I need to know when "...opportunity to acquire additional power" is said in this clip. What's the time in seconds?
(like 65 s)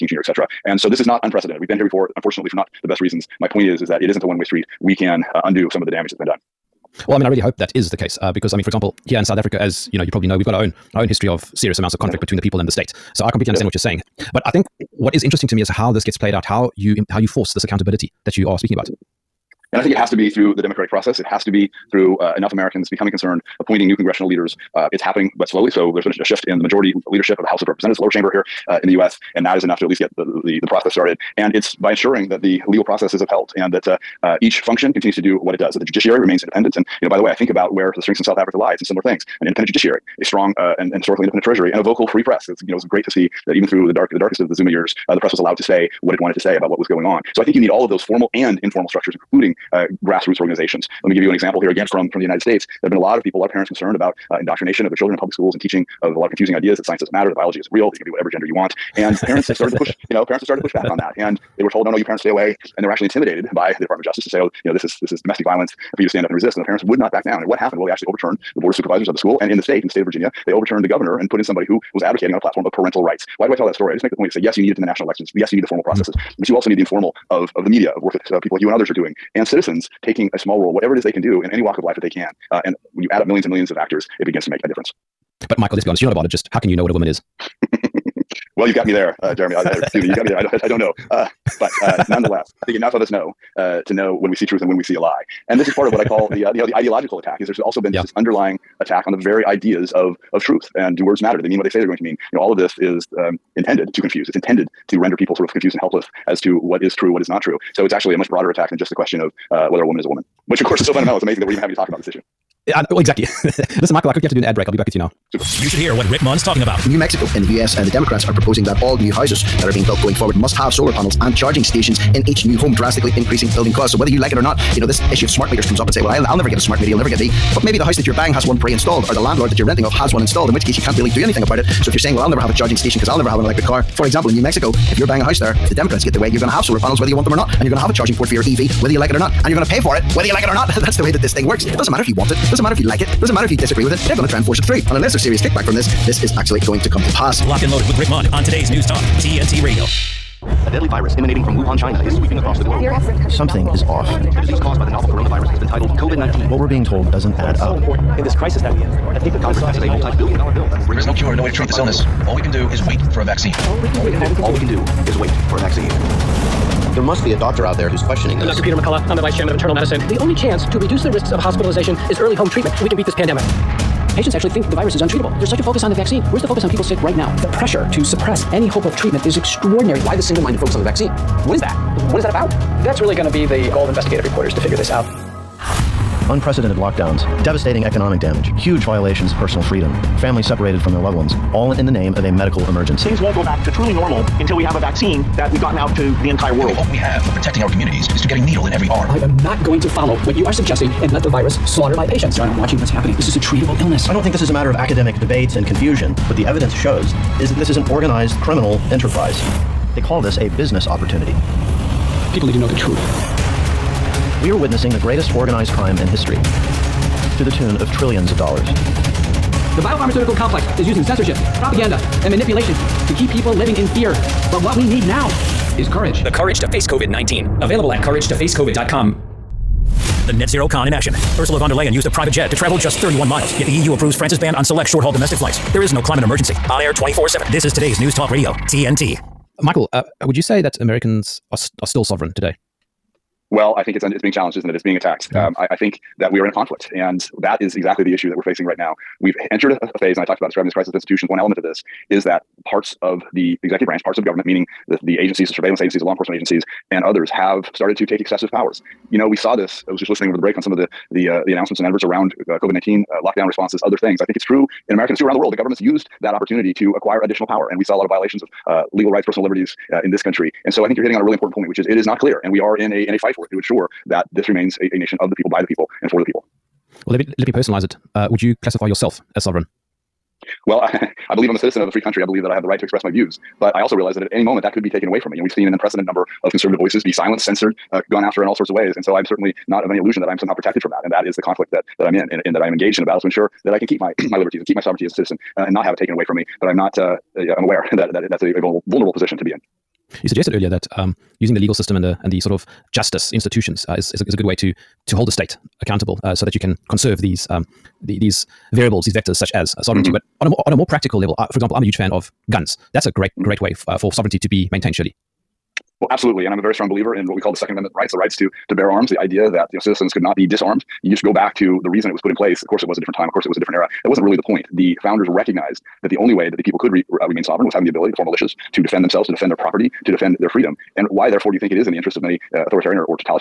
266 s.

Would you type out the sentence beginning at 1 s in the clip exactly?
We've been here before, unfortunately, for not the best reasons.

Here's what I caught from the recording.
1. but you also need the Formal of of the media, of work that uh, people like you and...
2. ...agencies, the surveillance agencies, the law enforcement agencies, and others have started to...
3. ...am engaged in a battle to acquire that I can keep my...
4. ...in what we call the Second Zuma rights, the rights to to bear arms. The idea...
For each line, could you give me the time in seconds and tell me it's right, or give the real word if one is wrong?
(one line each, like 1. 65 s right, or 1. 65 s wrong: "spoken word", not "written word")
1. 76 s right
2. 255 s right
3. 292 s wrong: "ensure", not "acquire"
4. 317 s wrong: "Amendment", not "Zuma".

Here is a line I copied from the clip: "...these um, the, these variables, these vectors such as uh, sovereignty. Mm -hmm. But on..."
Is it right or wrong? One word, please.
right.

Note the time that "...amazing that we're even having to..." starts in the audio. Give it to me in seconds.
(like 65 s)
111 s.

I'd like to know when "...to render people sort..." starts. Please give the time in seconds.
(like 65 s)
104 s.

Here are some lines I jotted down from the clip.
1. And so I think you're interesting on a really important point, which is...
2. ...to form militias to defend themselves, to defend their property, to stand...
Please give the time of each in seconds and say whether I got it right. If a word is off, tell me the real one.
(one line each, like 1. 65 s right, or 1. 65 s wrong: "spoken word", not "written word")
1. 270 s wrong: "hitting", not "interesting"
2. 328 s wrong: "defend", not "stand".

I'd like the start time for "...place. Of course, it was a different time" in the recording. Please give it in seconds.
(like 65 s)
322 s.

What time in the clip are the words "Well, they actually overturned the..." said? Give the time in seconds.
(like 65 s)
67 s.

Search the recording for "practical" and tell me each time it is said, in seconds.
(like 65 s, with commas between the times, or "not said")
310 s.